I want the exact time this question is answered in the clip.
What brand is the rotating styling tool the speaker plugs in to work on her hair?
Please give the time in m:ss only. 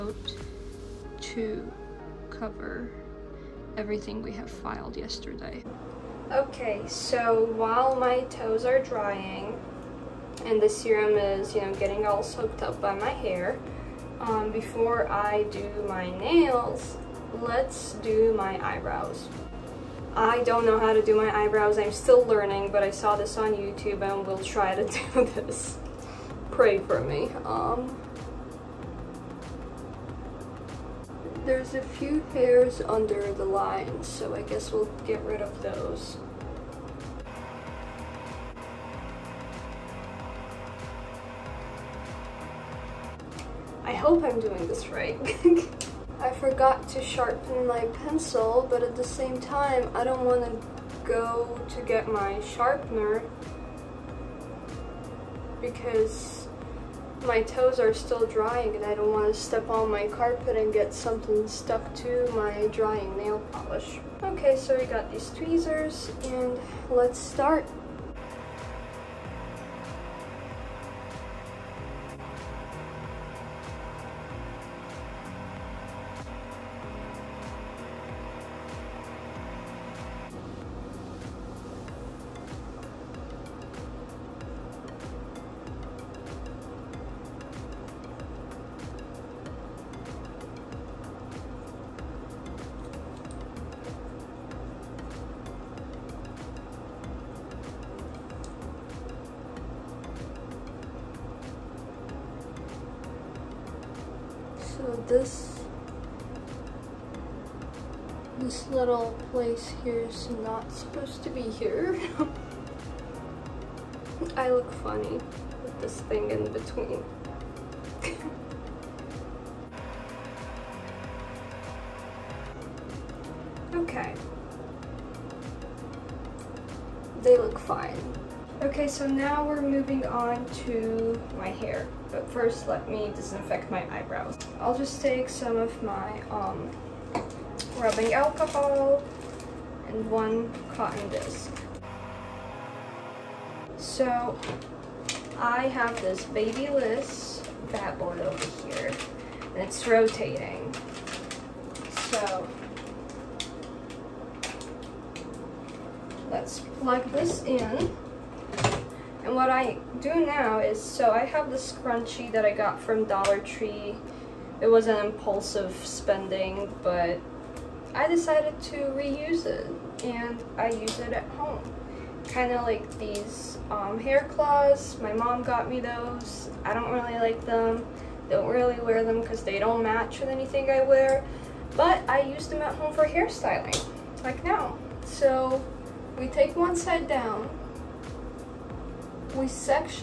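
2:26.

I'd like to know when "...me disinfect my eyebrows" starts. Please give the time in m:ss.
2:12.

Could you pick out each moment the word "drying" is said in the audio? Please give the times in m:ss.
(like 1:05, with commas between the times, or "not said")
0:08, 0:58, 1:02.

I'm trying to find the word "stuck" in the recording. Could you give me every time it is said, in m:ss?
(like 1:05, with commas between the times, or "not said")
1:01.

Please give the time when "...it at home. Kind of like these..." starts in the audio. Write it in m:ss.
2:51.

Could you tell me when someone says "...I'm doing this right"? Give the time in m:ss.
0:44.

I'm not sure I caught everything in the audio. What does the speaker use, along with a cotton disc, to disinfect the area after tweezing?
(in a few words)
rubbing alcohol.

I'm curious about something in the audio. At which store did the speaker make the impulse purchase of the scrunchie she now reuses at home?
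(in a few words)
Dollar Tree.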